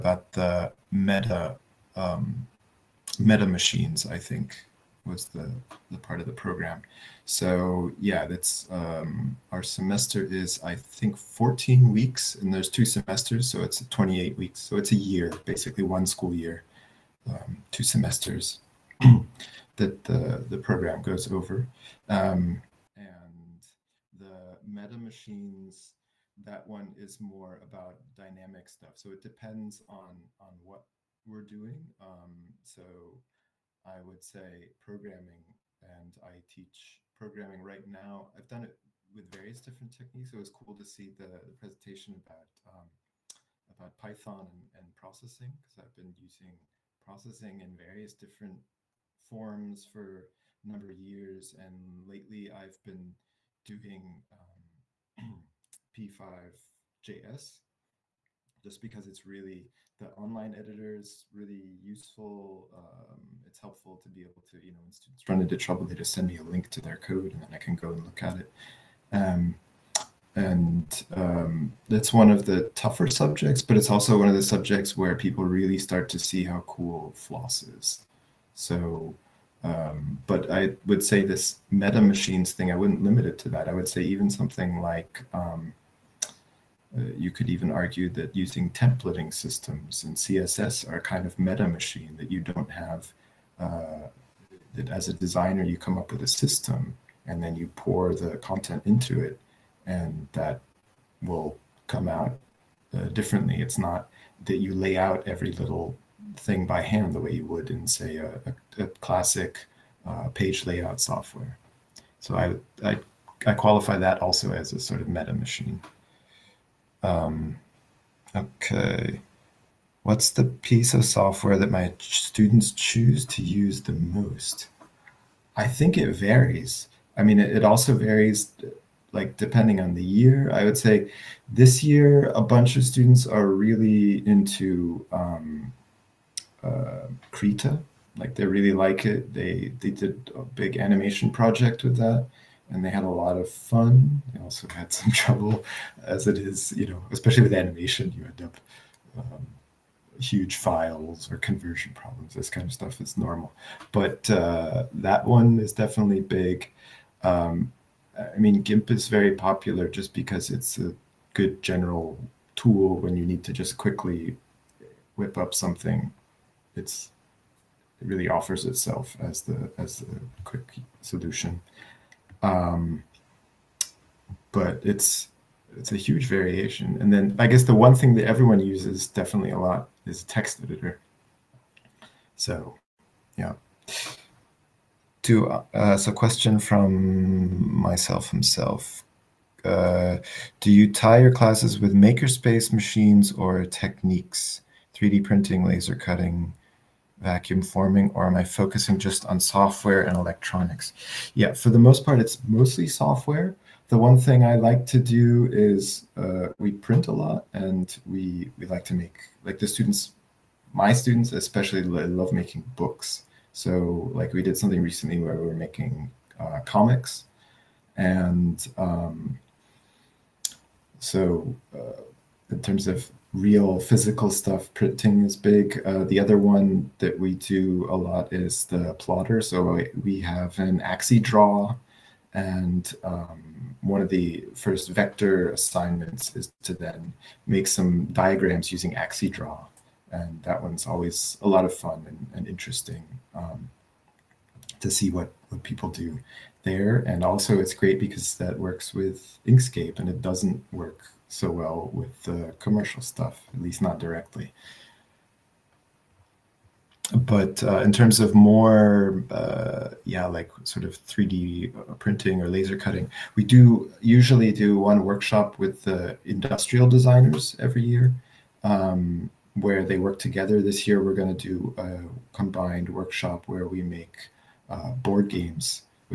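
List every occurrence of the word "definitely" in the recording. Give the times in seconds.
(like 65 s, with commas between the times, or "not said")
155 s, 179 s.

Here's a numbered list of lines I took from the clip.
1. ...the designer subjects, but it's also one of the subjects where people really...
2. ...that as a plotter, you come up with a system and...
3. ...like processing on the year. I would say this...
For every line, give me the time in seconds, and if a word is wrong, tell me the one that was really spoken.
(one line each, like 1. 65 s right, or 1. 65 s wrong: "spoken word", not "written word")
1. 72 s wrong: "tougher", not "designer"
2. 94 s wrong: "designer", not "plotter"
3. 129 s wrong: "depending", not "processing".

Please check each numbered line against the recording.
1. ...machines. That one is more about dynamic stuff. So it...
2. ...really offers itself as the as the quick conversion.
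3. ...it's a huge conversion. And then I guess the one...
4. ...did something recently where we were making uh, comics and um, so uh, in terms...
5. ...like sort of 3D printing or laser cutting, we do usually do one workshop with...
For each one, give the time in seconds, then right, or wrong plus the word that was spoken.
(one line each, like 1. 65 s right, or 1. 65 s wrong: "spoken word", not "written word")
1. 24 s right
2. 168 s wrong: "solution", not "conversion"
3. 175 s wrong: "variation", not "conversion"
4. 214 s right
5. 260 s right.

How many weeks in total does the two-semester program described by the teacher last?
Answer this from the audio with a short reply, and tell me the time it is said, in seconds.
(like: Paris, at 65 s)
28, at 13 s.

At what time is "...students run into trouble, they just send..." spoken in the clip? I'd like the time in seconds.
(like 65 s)
64 s.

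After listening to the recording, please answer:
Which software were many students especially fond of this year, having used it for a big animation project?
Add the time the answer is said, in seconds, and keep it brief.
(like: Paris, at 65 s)
Krita, at 137 s.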